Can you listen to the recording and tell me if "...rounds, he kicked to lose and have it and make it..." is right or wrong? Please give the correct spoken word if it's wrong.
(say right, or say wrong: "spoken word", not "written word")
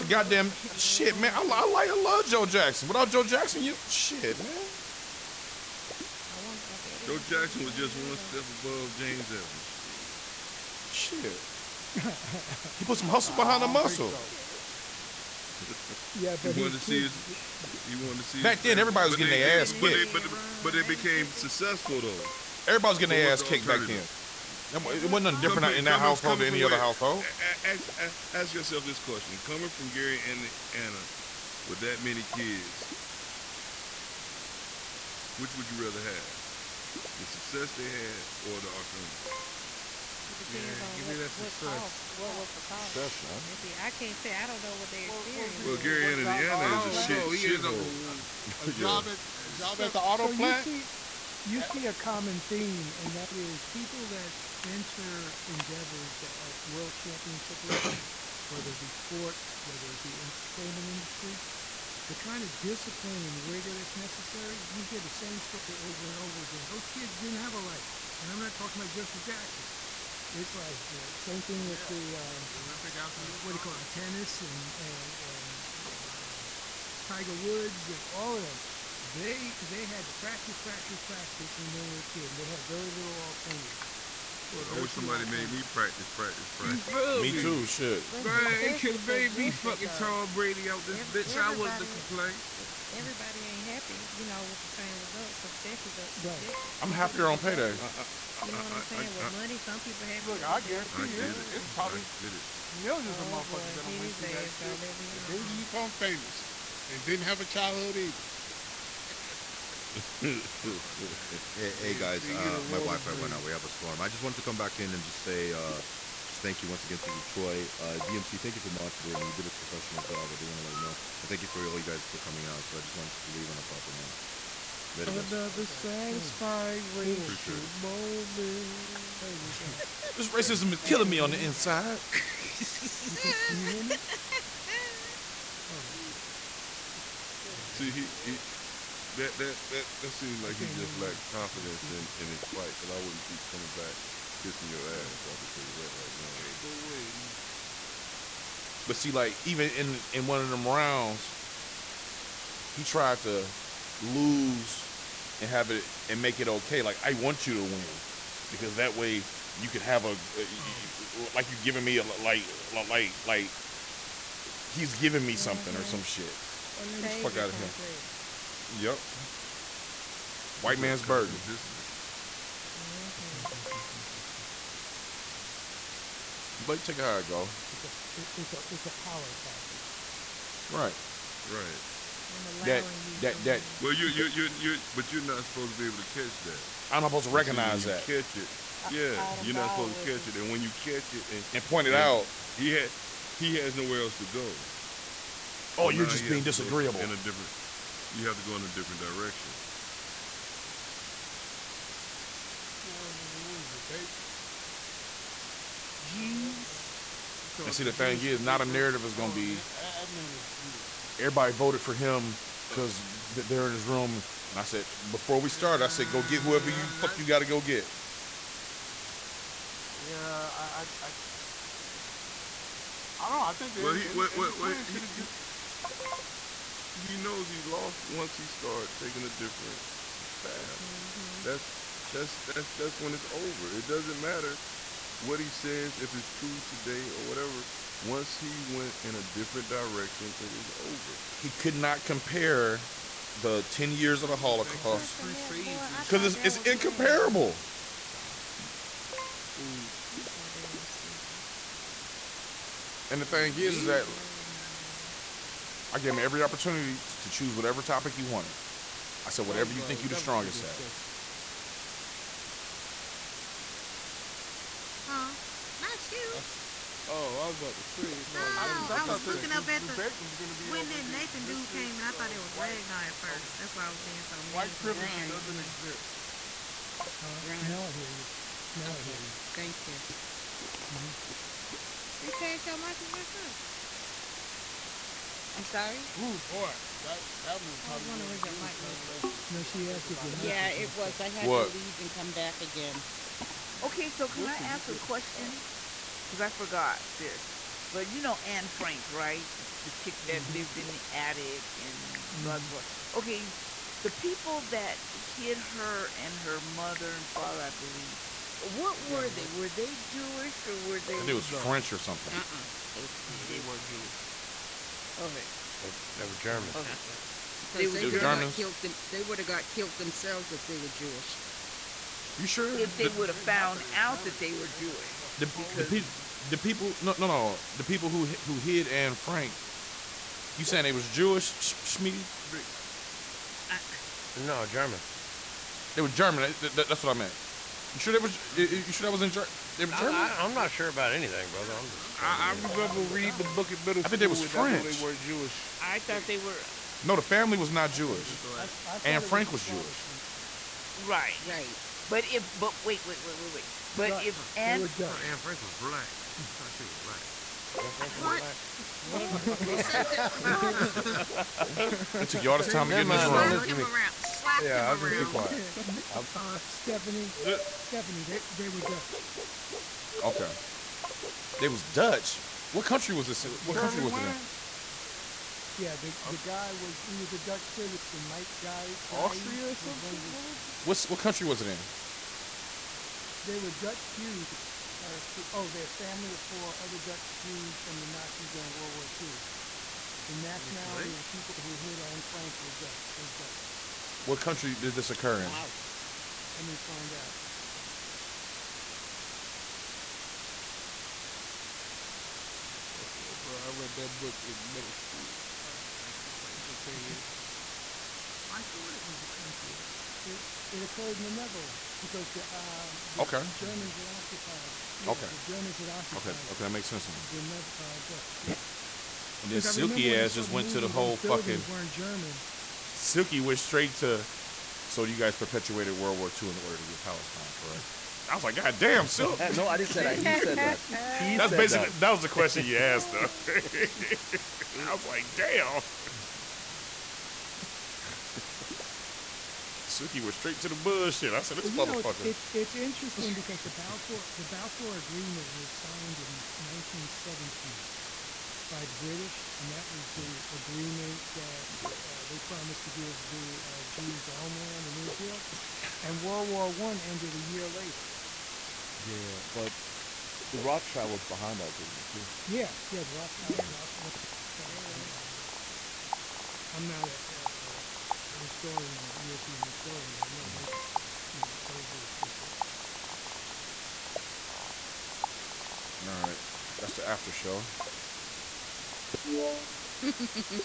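wrong: "tried", not "kicked".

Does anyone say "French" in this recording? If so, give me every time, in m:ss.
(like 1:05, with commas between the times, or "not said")
5:11, 5:44.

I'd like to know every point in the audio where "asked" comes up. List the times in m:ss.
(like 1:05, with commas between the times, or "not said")
4:49, 7:12.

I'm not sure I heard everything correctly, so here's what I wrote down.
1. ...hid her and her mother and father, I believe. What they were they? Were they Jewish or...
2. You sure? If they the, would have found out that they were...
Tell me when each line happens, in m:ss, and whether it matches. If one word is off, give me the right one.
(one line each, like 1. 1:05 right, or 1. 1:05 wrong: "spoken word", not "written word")
1. 5:05 right
2. 5:22 right.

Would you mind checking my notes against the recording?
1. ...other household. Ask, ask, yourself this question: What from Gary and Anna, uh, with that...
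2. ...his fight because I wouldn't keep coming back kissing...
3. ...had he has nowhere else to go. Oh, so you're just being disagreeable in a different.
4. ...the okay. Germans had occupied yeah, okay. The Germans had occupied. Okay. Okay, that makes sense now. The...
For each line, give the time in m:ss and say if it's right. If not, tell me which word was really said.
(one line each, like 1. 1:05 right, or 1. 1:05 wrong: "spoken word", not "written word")
1. 0:26 wrong: "Coming", not "What"
2. 2:22 right
3. 3:12 right
4. 6:53 right.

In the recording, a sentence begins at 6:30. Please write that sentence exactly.
The nationality of the people who hid Anne Frank were Dutch.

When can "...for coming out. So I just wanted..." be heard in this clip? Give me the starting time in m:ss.
2:02.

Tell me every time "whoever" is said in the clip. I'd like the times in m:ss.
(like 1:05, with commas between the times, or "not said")
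3:36.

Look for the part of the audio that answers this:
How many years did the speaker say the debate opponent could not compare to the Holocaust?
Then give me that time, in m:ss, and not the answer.
4:03.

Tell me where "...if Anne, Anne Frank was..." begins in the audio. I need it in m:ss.
5:54.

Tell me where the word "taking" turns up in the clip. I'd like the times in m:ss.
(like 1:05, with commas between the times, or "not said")
3:48.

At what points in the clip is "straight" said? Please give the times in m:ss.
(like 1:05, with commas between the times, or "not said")
7:03, 7:20.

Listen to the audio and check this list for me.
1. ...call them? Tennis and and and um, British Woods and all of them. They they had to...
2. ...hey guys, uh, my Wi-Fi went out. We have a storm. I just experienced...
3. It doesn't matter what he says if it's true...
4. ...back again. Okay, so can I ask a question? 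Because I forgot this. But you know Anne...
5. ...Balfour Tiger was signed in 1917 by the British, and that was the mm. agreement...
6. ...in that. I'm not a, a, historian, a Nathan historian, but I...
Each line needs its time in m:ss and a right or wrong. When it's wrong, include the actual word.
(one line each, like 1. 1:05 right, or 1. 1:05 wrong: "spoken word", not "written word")
1. 1:13 wrong: "Tiger", not "British"
2. 1:51 wrong: "wanted", not "experienced"
3. 3:53 right
4. 4:52 right
5. 7:24 wrong: "Agreement", not "Tiger"
6. 7:45 wrong: "European", not "Nathan".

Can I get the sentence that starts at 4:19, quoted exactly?
I said, whatever you think you're the strongest at.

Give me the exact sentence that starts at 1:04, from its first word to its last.
You hear the same story over and over again.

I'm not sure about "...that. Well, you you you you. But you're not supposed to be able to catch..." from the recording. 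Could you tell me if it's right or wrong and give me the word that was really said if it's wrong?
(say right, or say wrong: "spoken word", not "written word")
right.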